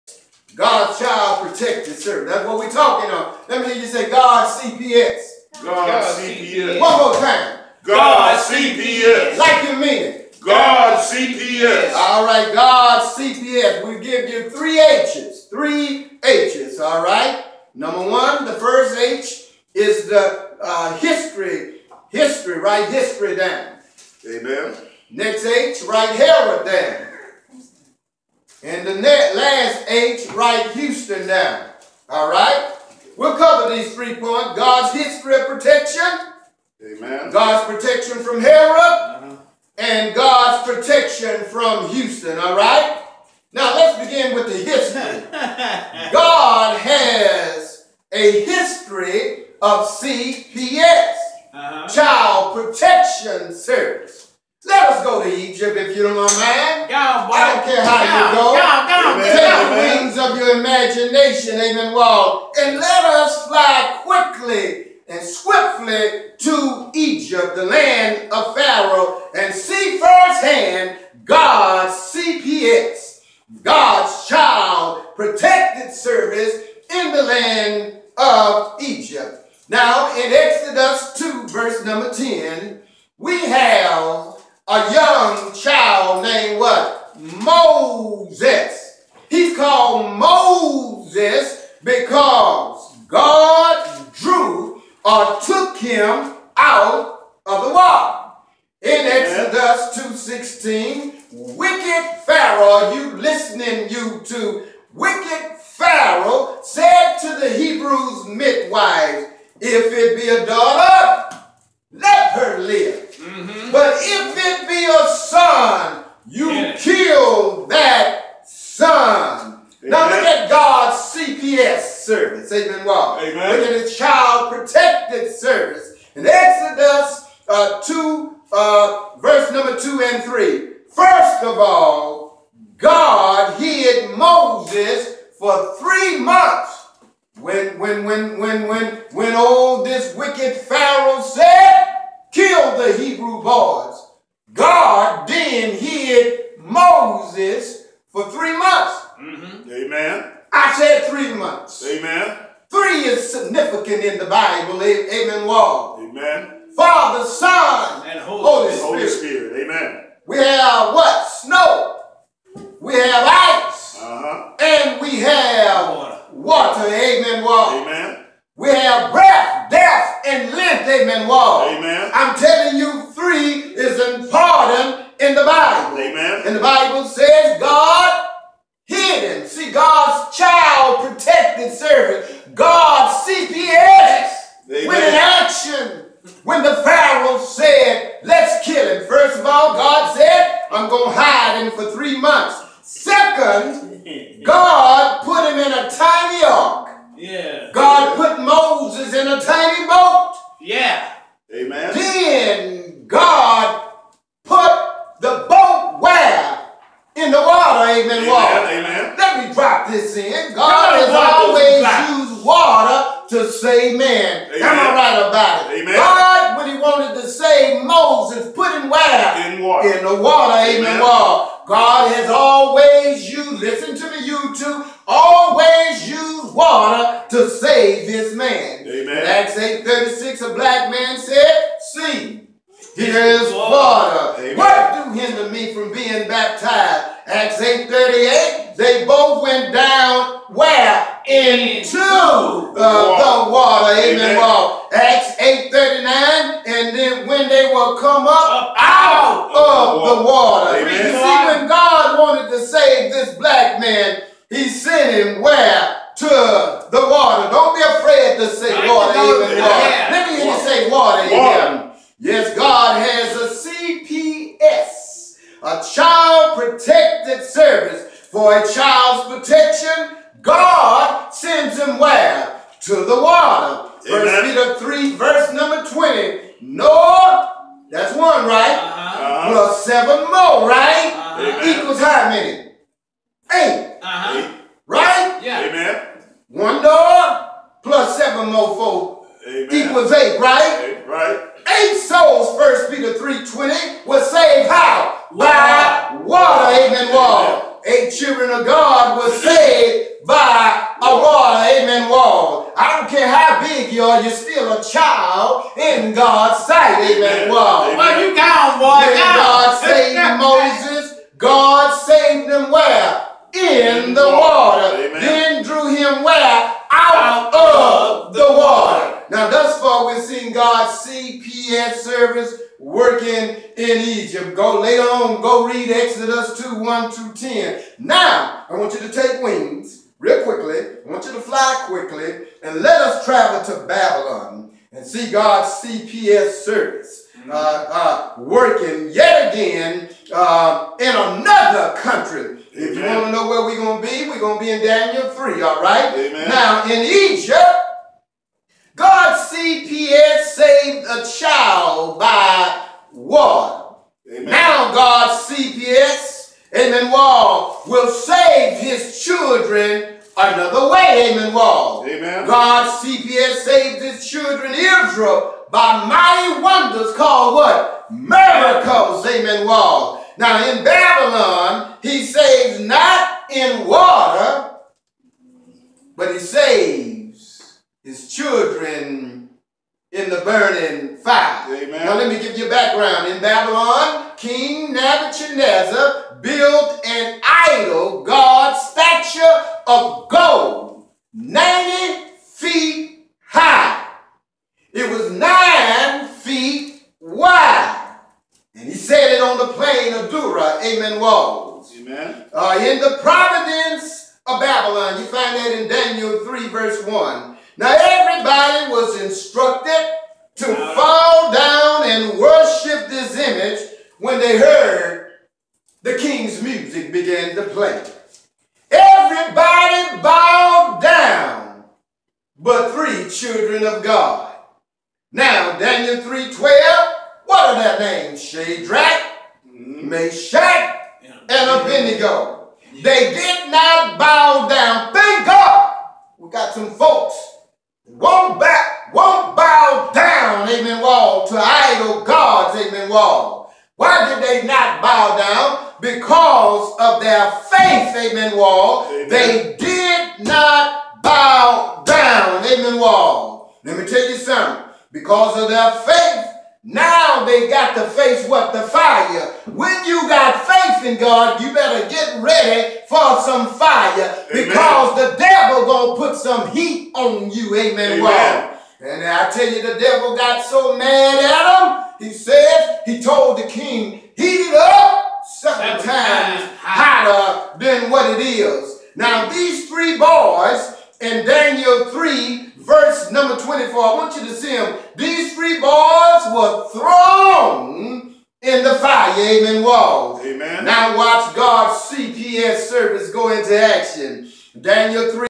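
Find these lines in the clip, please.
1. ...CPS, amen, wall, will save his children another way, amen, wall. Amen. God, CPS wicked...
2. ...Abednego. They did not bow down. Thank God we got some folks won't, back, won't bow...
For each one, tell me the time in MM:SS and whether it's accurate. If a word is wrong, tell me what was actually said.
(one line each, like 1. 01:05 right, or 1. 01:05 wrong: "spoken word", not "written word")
1. 05:55 wrong: "saved", not "wicked"
2. 07:11 right.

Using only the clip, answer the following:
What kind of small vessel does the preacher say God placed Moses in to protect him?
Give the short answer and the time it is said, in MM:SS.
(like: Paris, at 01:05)
A tiny ark, at 03:15.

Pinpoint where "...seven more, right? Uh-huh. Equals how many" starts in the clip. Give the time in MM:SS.
04:39.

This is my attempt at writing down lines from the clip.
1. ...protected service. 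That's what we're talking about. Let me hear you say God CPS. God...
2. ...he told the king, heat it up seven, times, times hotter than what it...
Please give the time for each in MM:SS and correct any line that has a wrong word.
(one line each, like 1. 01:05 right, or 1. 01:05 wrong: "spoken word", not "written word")
1. 00:01 right
2. 07:53 right.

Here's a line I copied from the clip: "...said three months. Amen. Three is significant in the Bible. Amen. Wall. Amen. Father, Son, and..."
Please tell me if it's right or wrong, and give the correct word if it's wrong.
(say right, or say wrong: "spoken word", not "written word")
right.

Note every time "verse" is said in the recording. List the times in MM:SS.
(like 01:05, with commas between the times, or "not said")
02:09, 04:35, 06:46.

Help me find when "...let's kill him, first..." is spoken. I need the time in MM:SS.
03:08.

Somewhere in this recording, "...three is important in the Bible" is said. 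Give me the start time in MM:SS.
02:53.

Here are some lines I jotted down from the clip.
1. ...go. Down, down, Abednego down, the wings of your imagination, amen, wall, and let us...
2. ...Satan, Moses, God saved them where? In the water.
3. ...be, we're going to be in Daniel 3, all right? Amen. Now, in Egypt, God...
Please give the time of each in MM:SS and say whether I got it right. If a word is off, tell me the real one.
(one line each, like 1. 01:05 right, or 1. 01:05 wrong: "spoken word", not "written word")
1. 00:58 wrong: "Take", not "Abednego"
2. 05:10 right
3. 05:44 right.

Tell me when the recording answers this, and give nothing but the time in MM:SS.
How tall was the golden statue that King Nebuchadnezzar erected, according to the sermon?
06:31.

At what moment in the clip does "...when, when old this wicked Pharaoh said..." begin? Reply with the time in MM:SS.
02:18.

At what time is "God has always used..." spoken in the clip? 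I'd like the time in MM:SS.
03:41.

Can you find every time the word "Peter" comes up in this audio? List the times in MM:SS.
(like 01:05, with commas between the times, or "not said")
04:34, 04:52.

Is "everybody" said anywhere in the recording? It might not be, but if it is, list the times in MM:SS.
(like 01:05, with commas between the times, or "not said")
06:47, 06:59.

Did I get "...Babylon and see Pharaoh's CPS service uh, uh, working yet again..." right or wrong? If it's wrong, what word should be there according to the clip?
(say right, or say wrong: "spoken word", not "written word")
wrong: "God", not "Pharaoh".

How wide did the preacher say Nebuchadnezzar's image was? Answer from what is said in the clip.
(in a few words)
9 feet.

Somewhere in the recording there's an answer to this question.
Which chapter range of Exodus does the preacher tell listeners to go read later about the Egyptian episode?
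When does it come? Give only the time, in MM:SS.
05:25.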